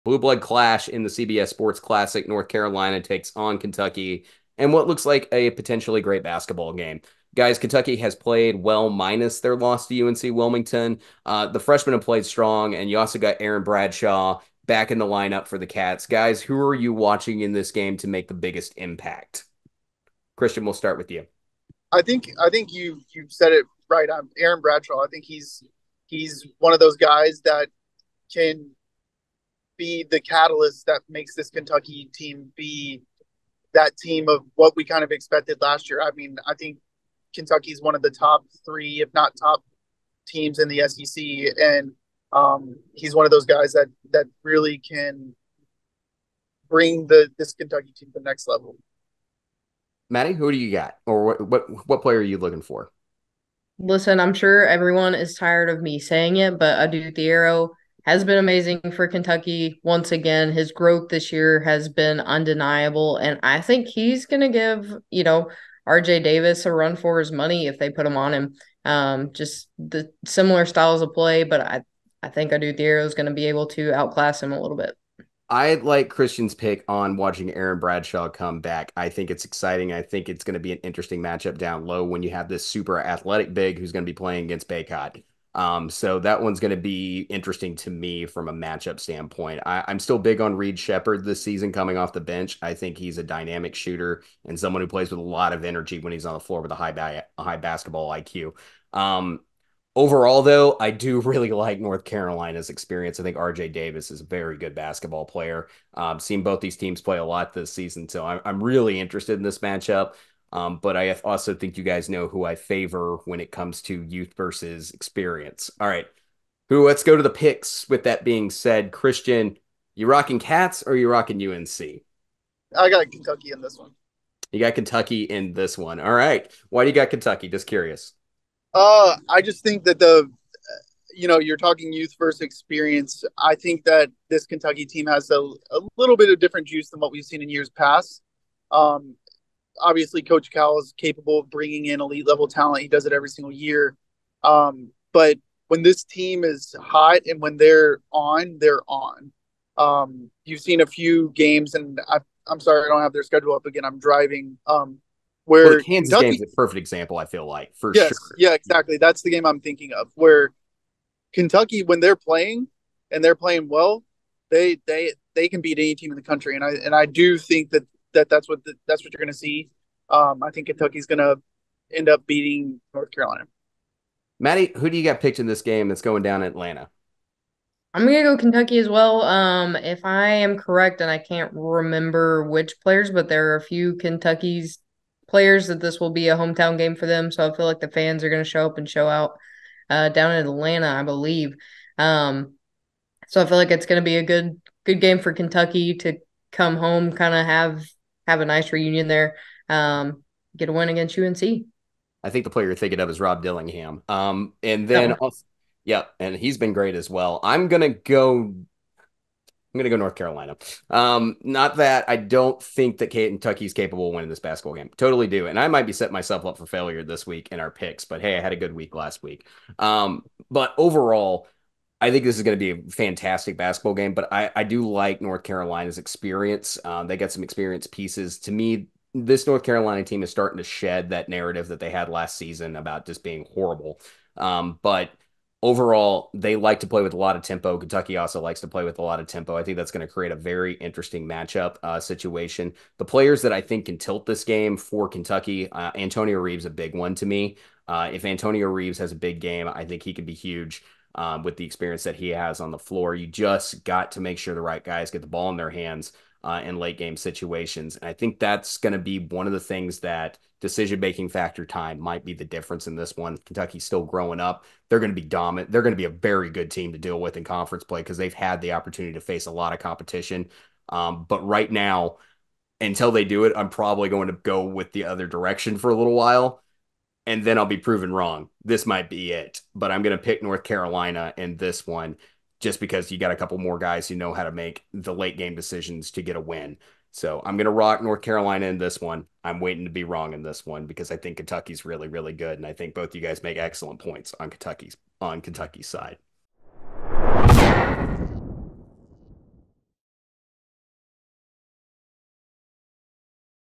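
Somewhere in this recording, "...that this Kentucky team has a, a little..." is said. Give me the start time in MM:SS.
02:13.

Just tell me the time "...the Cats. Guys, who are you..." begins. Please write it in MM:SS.
00:15.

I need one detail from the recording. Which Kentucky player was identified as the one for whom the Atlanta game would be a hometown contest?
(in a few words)
Rob Dillingham.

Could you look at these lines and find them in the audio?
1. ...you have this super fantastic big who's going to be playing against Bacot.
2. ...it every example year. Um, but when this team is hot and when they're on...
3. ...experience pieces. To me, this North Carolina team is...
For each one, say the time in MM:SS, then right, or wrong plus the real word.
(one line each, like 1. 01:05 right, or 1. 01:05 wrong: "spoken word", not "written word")
1. 01:22 wrong: "athletic", not "fantastic"
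2. 02:23 wrong: "single", not "example"
3. 03:47 right.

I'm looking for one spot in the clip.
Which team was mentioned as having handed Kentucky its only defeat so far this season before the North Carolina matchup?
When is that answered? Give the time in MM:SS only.
00:10.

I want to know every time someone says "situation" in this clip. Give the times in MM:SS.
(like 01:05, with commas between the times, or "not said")
04:01, 04:17.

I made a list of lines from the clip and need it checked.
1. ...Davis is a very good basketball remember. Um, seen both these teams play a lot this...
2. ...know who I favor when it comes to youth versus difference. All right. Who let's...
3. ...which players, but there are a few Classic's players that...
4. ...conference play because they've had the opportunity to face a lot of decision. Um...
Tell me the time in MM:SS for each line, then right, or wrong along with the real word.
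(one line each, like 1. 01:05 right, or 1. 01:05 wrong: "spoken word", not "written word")
1. 01:43 wrong: "player", not "remember"
2. 01:52 wrong: "experience", not "difference"
3. 03:02 wrong: "Kentucky", not "Classic"
4. 04:27 wrong: "competition", not "decision".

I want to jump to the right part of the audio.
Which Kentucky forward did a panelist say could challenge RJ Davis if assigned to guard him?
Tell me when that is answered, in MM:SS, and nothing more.
00:56.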